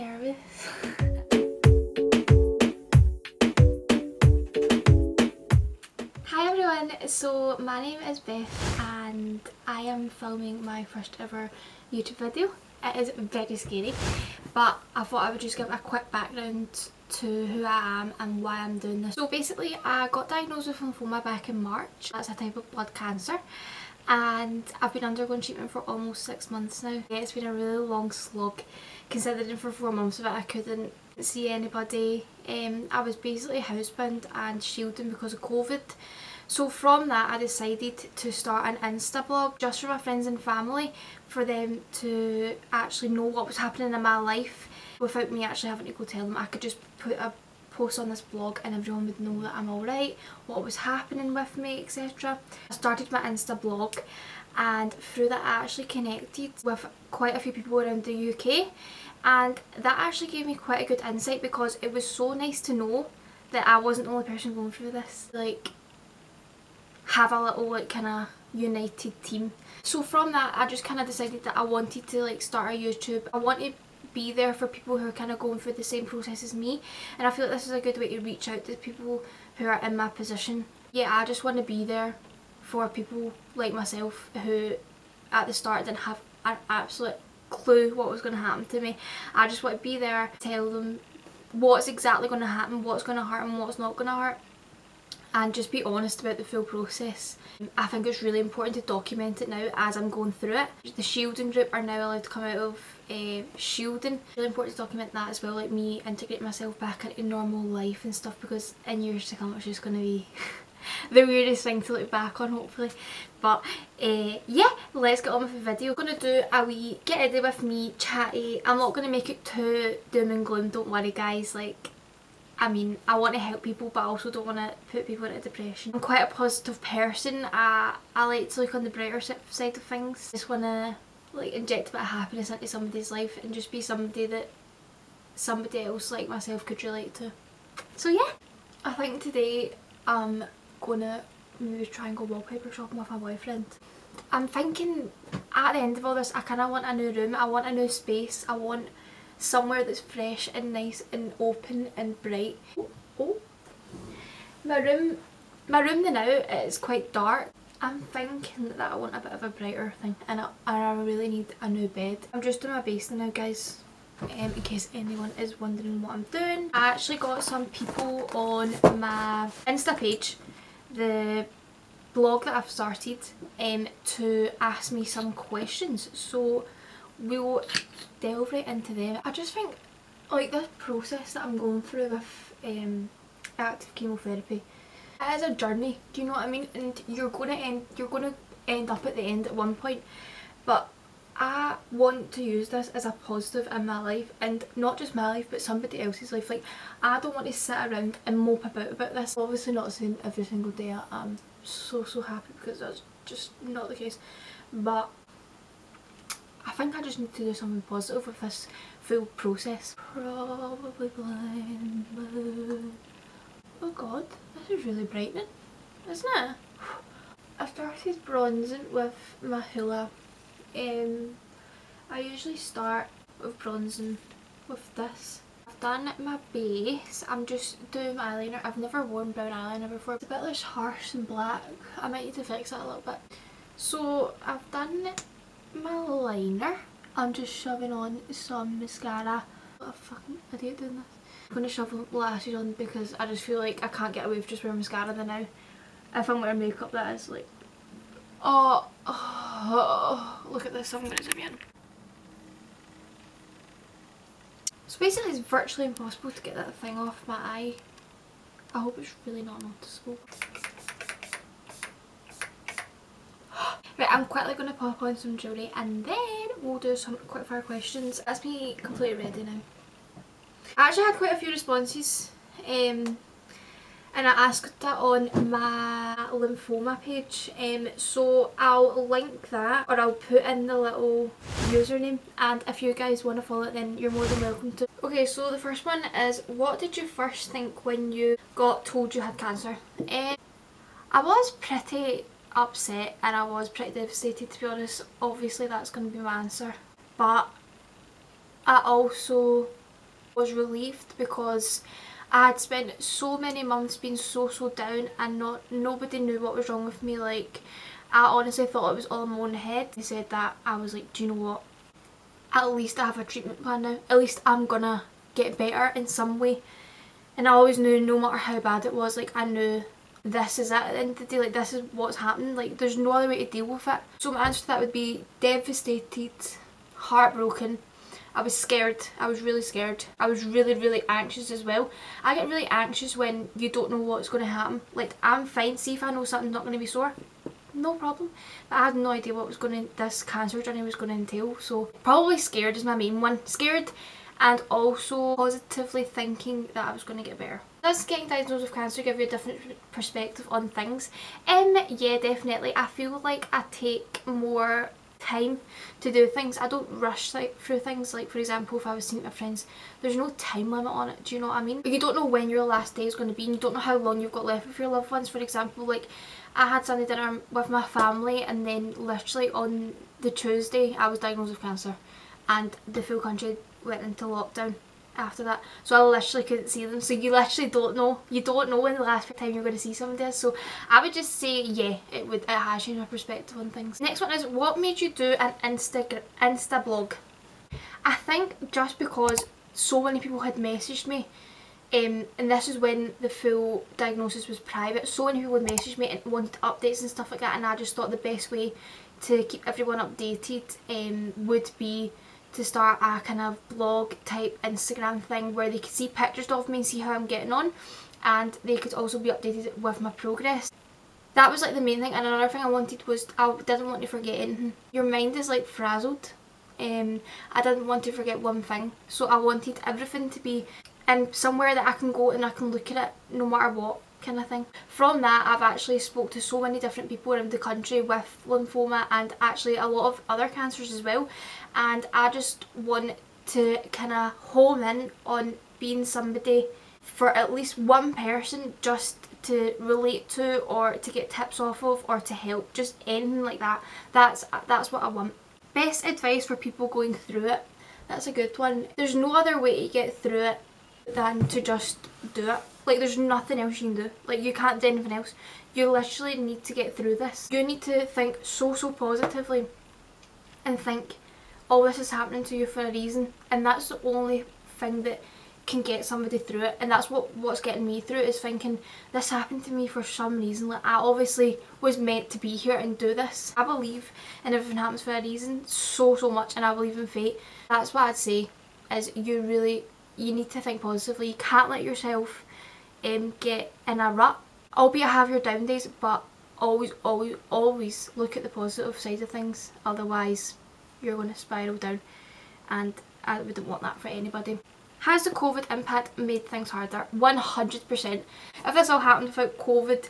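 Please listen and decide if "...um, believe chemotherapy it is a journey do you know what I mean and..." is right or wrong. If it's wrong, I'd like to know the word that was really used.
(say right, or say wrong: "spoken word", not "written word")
wrong: "active", not "believe".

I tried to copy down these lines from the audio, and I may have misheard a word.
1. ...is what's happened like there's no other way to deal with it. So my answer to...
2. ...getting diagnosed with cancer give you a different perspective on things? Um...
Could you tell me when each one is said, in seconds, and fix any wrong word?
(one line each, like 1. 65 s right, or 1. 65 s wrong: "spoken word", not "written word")
1. 321 s right
2. 348 s right.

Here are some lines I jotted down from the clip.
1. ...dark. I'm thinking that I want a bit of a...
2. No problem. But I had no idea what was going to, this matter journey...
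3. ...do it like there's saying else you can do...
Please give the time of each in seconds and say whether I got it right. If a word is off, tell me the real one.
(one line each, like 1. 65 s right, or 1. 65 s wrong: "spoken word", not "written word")
1. 157 s right
2. 337 s wrong: "cancer", not "matter"
3. 452 s wrong: "nothing", not "saying".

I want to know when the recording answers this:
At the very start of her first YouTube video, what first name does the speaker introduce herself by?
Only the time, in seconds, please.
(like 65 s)
8 s.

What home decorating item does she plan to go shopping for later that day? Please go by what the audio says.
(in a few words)
Wallpaper.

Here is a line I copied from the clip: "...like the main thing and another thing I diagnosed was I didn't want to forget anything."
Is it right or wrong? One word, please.
wrong.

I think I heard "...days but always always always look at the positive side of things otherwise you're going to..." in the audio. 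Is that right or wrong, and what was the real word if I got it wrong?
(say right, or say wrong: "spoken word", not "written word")
right.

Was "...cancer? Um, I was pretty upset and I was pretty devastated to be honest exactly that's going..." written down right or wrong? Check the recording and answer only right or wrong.
wrong.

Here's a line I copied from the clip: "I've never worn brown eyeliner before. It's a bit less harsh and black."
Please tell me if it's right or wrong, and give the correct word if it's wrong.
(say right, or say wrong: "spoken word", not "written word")
right.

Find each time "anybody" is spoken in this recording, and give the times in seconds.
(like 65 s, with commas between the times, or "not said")
31 s, 494 s.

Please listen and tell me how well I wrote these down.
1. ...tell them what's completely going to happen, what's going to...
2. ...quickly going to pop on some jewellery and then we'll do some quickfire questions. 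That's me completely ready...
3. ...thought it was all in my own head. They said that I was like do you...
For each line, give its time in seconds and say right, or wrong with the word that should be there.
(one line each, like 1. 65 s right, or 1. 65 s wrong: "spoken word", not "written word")
1. 90 s wrong: "exactly", not "completely"
2. 264 s right
3. 308 s right.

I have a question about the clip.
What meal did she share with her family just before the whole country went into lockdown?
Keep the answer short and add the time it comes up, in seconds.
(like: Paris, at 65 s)
Sunday dinner, at 366 s.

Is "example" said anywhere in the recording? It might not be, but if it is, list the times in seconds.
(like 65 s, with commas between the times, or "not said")
358 s, 365 s.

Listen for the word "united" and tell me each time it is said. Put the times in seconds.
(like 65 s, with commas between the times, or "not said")
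68 s.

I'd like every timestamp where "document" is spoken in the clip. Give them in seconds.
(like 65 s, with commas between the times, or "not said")
98 s, 104 s.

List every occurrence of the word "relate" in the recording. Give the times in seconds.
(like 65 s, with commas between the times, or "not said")
136 s, 439 s.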